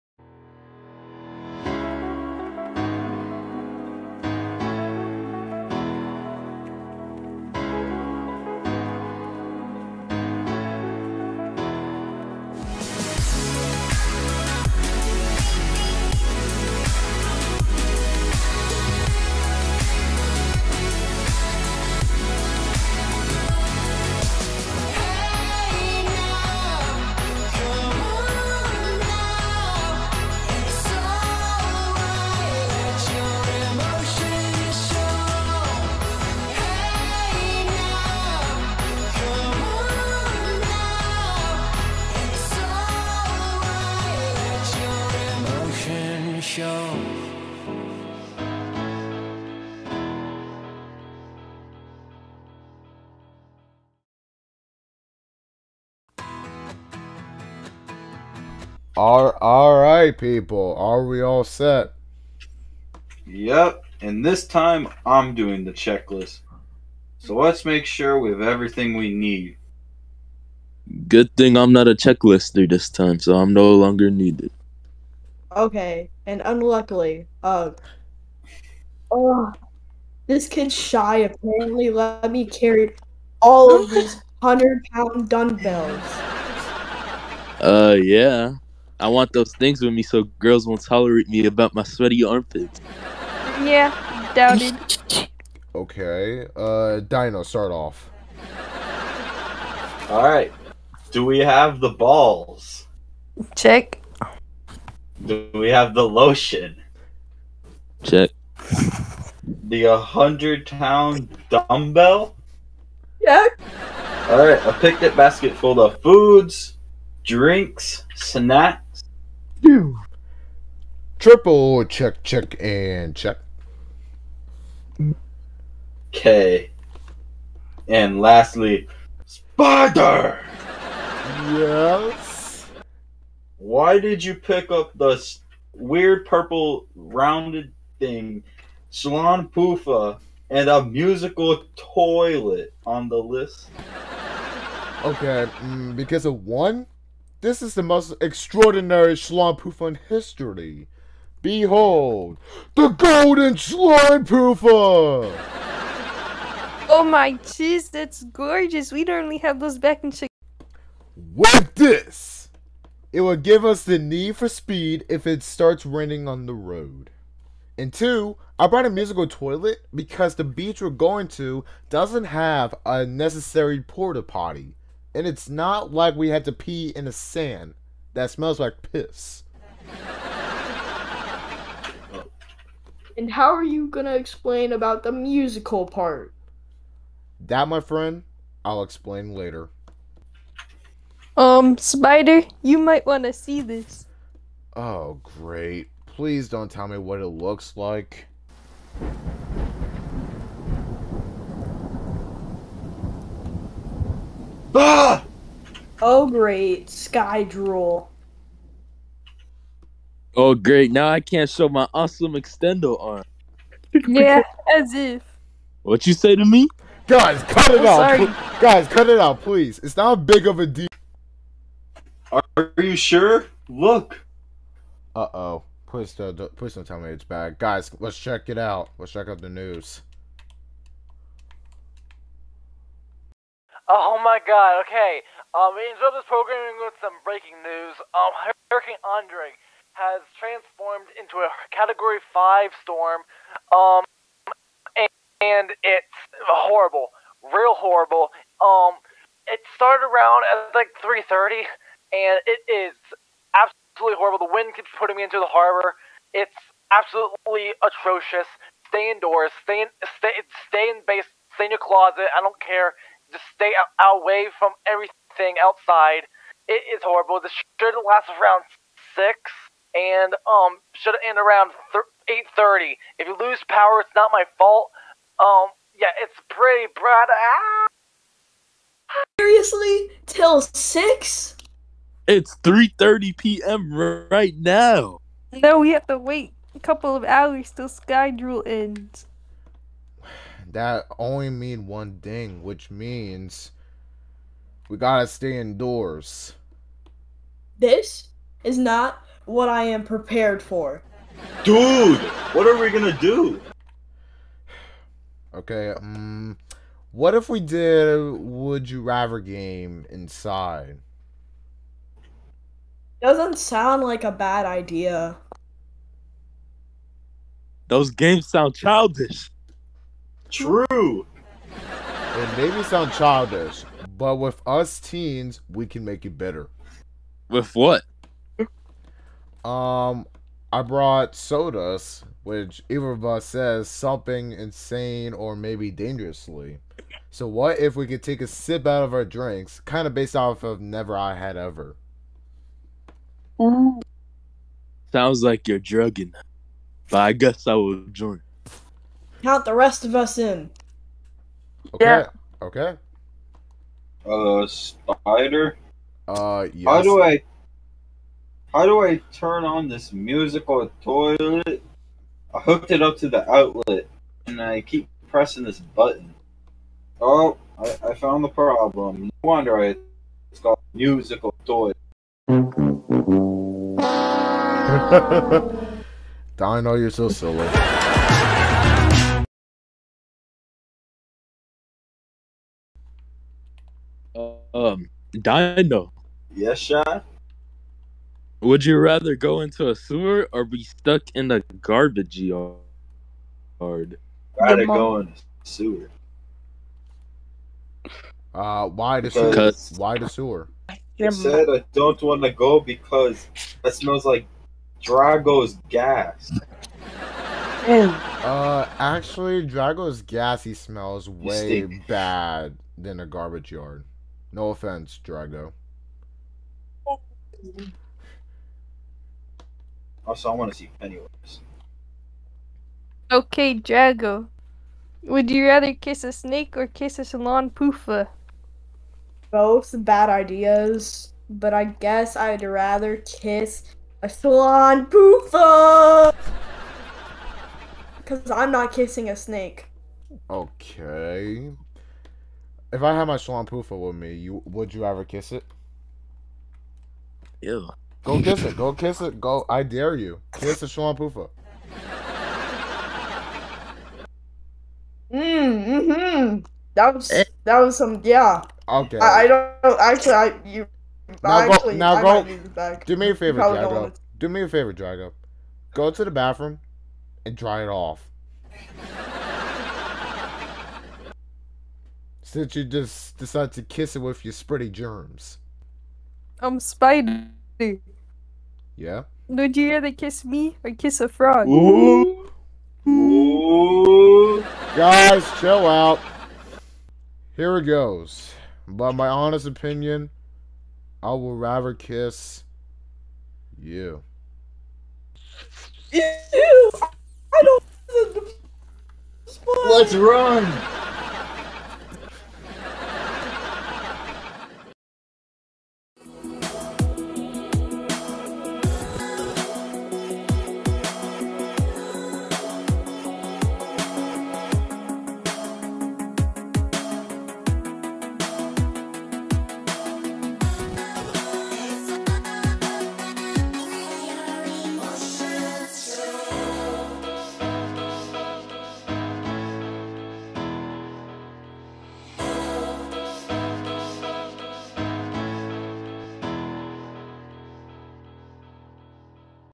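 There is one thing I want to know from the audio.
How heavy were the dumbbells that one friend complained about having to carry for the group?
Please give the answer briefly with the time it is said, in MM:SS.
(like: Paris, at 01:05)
100 pounds, at 01:24.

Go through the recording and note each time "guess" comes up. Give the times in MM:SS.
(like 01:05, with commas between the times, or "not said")
05:47, 07:11.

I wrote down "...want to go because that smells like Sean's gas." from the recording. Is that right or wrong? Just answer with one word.
wrong.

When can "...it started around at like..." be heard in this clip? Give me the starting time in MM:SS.
04:09.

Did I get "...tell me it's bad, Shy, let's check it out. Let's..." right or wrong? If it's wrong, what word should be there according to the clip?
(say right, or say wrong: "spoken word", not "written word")
wrong: "Guys", not "Shy".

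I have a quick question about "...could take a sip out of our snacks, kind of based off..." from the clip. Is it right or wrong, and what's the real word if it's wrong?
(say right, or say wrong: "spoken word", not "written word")
wrong: "drinks", not "snacks".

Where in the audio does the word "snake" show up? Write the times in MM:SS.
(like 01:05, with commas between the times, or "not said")
07:06, 07:19.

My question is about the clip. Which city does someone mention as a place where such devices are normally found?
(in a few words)
Chicago.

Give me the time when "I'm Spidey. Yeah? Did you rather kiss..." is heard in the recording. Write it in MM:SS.
07:56.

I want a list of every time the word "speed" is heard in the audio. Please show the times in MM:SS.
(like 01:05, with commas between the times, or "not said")
02:44.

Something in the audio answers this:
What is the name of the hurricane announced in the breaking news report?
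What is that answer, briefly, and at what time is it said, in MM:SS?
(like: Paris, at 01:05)
Hurricane Andre, at 03:58.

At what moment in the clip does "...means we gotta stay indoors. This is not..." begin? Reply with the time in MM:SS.
04:52.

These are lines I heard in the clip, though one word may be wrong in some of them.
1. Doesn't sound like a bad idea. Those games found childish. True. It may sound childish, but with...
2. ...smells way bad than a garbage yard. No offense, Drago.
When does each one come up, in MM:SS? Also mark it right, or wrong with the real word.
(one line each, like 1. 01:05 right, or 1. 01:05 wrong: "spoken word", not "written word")
1. 05:13 wrong: "sound", not "found"
2. 06:50 right.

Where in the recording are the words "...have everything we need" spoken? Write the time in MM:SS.
01:08.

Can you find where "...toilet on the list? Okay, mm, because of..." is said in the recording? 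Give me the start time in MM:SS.
02:21.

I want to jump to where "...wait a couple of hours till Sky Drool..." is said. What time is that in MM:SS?
04:46.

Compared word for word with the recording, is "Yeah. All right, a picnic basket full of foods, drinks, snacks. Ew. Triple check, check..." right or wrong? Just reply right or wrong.
right.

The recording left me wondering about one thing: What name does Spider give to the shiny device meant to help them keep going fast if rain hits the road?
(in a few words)
golden slime proofer.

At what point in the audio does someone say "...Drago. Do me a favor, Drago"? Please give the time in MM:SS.
07:43.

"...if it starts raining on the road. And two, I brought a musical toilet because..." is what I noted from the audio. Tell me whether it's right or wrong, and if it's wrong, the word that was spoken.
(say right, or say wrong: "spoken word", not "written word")
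right.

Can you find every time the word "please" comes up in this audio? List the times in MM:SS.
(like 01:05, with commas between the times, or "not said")
03:16, 03:39.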